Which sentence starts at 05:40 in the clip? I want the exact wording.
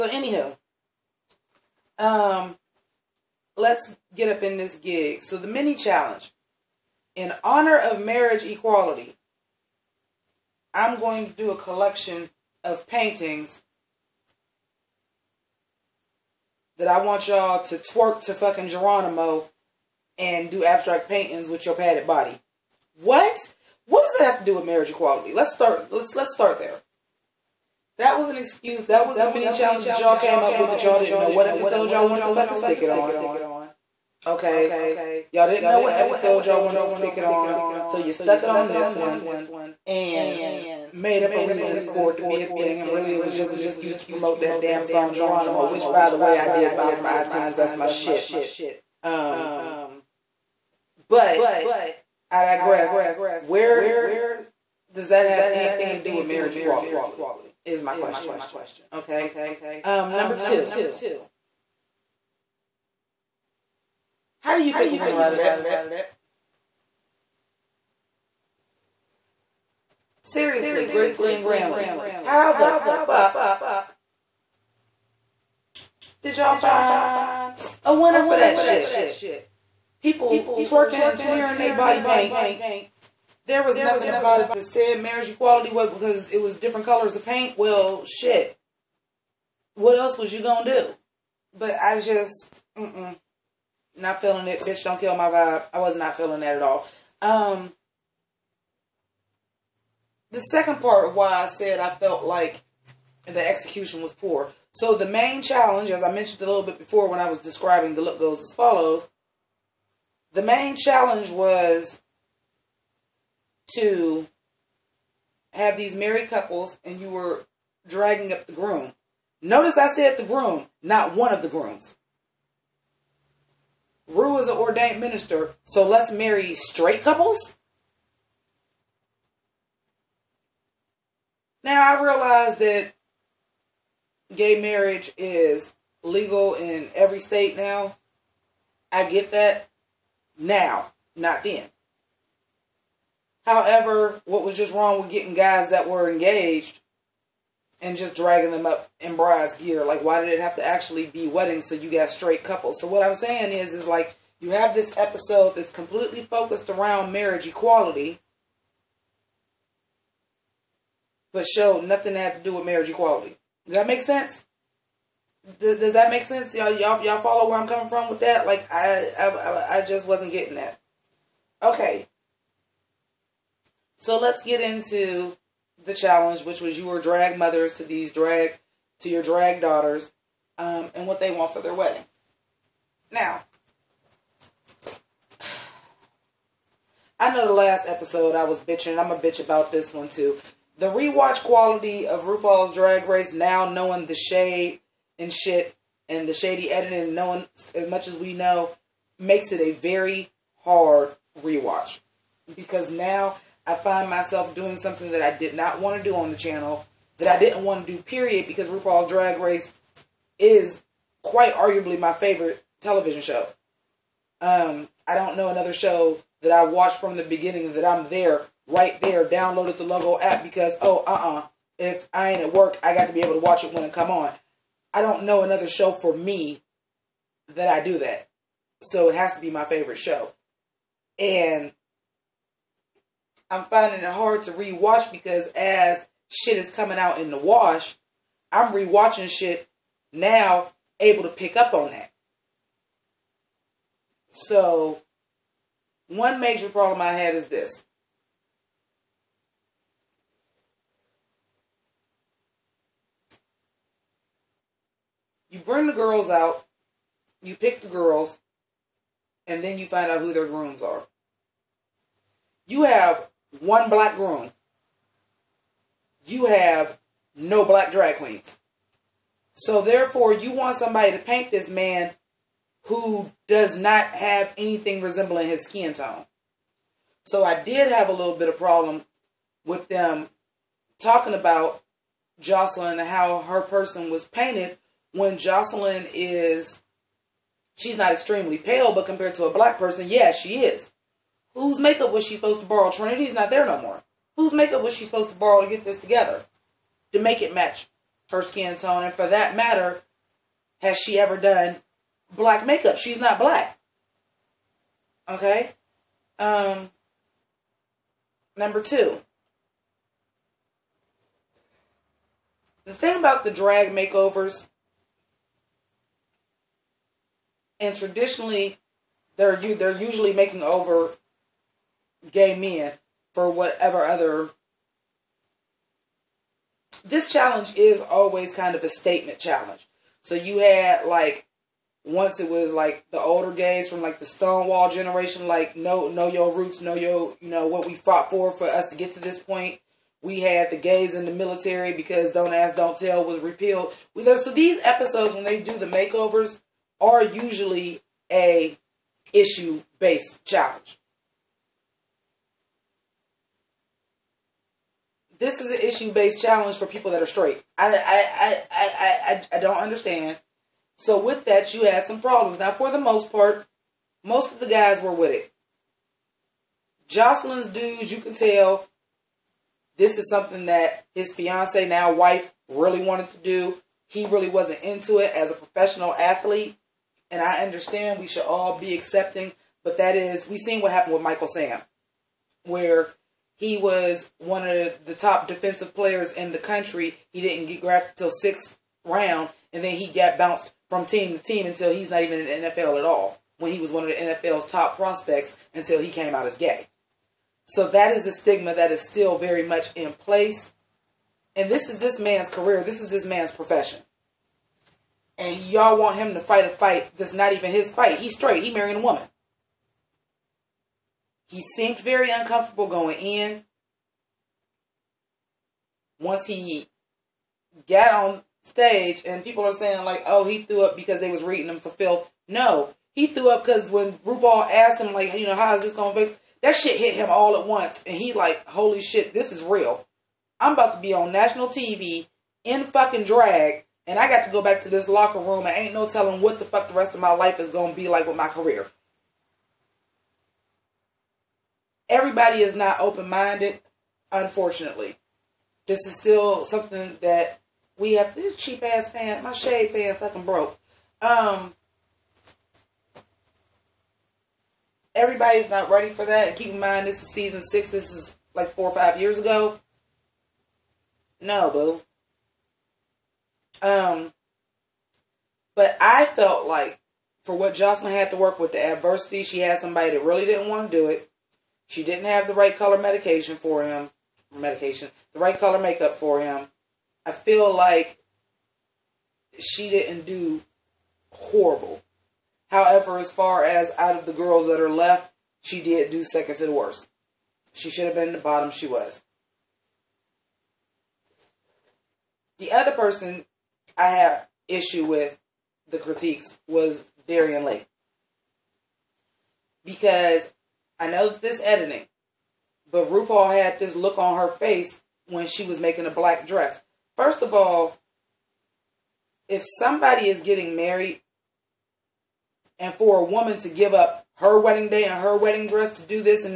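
We had the gays in the military because "Don't Ask, Don't Tell" was repealed.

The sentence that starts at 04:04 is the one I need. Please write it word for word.
So one major problem I had is this.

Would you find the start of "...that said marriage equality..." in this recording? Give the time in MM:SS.
01:24.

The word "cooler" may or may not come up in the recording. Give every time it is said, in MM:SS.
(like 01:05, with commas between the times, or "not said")
not said.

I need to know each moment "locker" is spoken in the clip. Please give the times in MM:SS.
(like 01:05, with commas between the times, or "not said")
07:15.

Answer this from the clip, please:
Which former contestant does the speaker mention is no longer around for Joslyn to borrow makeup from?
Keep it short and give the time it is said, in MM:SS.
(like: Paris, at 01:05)
Trinity, at 04:52.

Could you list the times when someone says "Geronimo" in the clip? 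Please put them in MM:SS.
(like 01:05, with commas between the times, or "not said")
00:18, 00:45.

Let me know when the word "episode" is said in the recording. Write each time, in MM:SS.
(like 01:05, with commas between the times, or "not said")
00:31, 00:35, 02:34, 03:07, 05:44.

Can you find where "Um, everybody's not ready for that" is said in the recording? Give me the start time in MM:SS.
07:31.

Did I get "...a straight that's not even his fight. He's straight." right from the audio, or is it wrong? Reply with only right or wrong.
wrong.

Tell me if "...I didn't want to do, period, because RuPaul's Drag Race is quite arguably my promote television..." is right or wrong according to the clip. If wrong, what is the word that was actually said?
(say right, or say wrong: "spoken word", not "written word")
wrong: "favorite", not "promote".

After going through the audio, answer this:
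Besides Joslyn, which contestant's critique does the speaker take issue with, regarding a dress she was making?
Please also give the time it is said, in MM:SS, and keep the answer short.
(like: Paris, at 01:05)
Darienne Lake, at 08:17.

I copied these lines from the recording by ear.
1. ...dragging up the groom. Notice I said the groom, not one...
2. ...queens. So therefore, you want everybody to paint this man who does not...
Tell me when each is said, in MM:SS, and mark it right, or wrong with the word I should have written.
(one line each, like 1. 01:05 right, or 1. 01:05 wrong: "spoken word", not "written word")
1. 01:57 right
2. 04:28 wrong: "somebody", not "everybody".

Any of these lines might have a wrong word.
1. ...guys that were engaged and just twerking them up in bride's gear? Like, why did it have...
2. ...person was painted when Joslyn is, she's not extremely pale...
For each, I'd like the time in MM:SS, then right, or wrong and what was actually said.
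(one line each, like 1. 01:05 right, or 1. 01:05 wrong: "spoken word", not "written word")
1. 02:25 wrong: "dragging", not "twerking"
2. 04:43 right.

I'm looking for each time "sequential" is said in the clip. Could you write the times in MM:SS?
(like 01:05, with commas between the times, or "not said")
not said.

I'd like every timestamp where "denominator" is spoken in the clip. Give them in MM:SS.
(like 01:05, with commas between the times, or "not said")
not said.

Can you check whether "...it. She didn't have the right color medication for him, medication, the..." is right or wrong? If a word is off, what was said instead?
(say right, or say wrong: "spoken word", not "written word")
right.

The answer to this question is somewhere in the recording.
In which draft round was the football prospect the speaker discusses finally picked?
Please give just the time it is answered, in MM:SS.
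06:28.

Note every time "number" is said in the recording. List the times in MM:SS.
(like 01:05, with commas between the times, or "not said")
01:00, 05:08.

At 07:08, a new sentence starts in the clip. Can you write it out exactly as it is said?
And he like, holy shit, this is real.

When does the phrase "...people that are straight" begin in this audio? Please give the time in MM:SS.
05:56.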